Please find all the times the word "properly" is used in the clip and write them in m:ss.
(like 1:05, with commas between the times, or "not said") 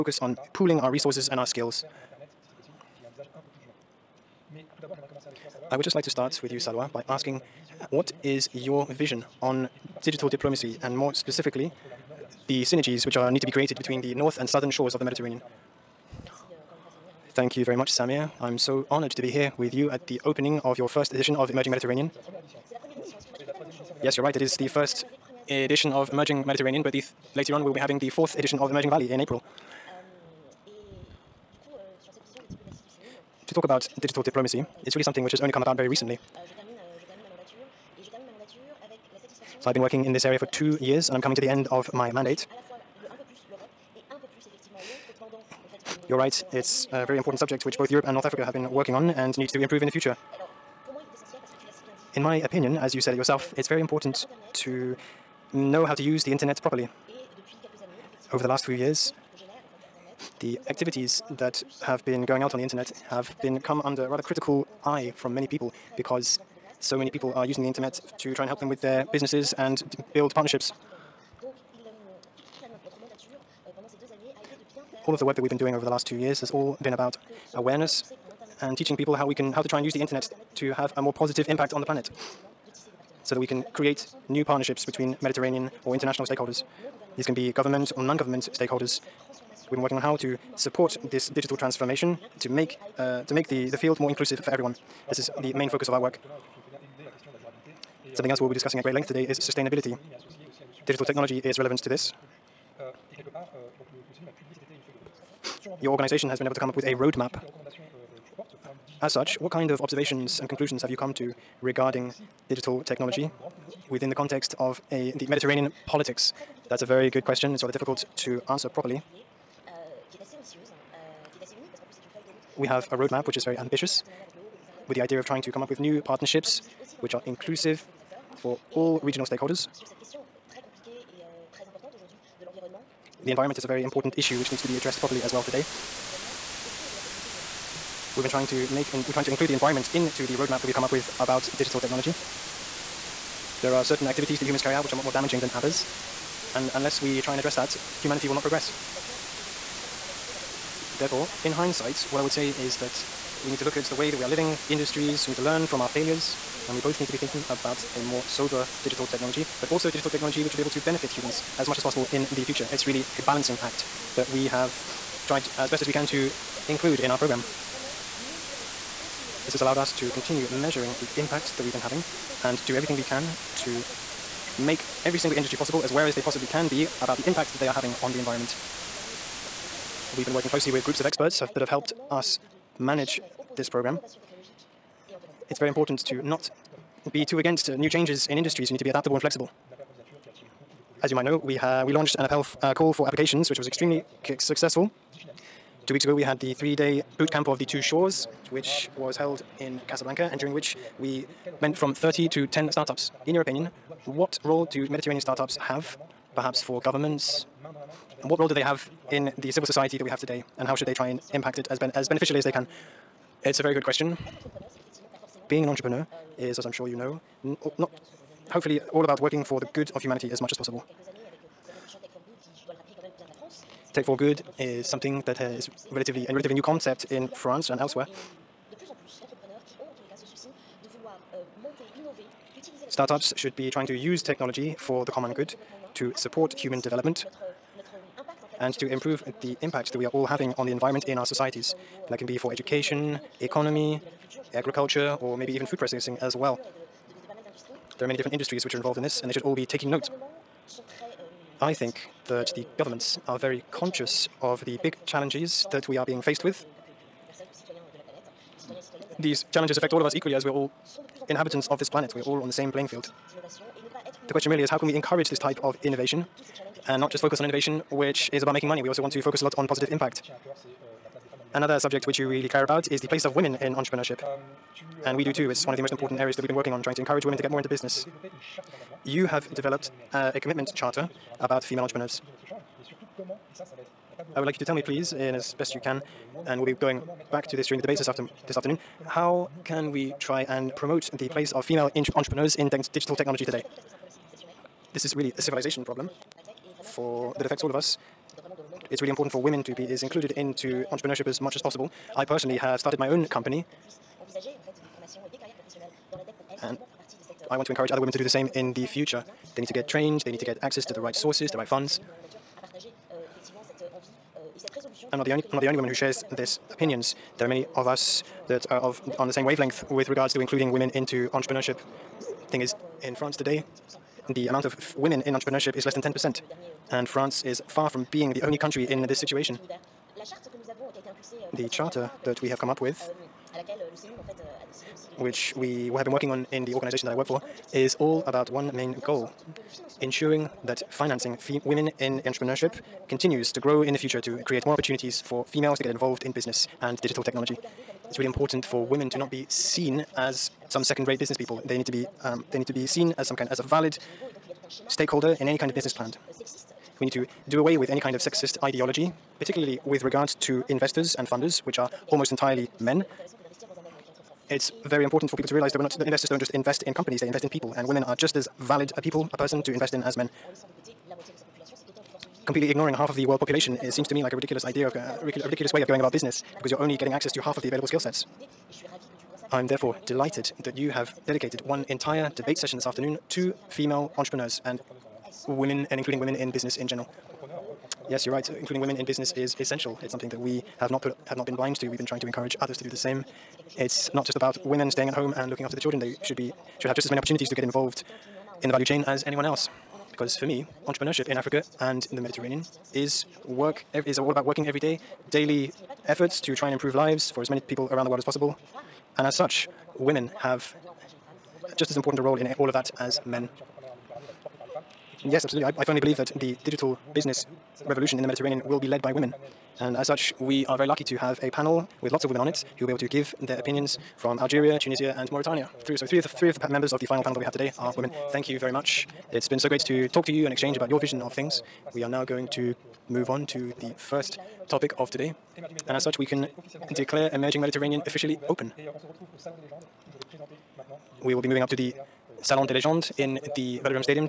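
0:56, 1:58, 2:14.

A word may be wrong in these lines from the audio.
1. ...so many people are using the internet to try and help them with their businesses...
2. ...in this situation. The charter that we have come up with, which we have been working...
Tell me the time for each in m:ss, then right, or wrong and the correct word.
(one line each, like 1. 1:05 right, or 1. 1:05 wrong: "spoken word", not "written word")
1. 1:06 right
2. 5:28 right.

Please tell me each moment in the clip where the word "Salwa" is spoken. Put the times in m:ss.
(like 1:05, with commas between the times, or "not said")
0:06.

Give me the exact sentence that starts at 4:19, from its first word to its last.
These challenges affect all of us equally as we're all inhabitants of this planet.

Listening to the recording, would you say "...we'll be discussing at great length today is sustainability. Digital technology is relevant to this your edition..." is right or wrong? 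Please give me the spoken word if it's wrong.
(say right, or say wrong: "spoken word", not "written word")
wrong: "organization", not "edition".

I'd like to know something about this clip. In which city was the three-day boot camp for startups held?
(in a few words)
Casablanca.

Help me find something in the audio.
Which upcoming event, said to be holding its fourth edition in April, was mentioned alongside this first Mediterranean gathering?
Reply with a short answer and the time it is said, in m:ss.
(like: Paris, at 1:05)
Emerging Valley, at 0:28.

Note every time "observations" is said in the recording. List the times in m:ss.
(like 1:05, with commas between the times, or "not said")
1:49.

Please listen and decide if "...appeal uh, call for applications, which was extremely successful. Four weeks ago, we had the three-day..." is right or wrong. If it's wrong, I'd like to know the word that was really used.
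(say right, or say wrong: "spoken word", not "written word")
wrong: "Two", not "Four".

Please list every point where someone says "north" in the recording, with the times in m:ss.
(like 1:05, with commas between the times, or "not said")
0:14, 0:48.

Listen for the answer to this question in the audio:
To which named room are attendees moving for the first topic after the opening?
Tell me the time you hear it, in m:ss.
7:22.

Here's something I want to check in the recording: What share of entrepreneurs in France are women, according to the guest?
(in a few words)
less than 10 percent.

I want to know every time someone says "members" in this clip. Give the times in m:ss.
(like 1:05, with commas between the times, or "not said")
7:06.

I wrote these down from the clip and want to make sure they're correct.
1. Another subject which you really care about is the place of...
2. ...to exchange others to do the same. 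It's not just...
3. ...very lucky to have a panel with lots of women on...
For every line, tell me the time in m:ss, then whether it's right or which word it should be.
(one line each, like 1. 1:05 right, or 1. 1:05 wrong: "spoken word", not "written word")
1. 4:31 right
2. 6:32 wrong: "encourage", not "exchange"
3. 7:00 right.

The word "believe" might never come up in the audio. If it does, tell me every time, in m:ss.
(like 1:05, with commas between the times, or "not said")
6:55.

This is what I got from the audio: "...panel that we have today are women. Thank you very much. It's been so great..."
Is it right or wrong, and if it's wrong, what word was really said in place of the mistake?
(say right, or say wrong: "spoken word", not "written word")
right.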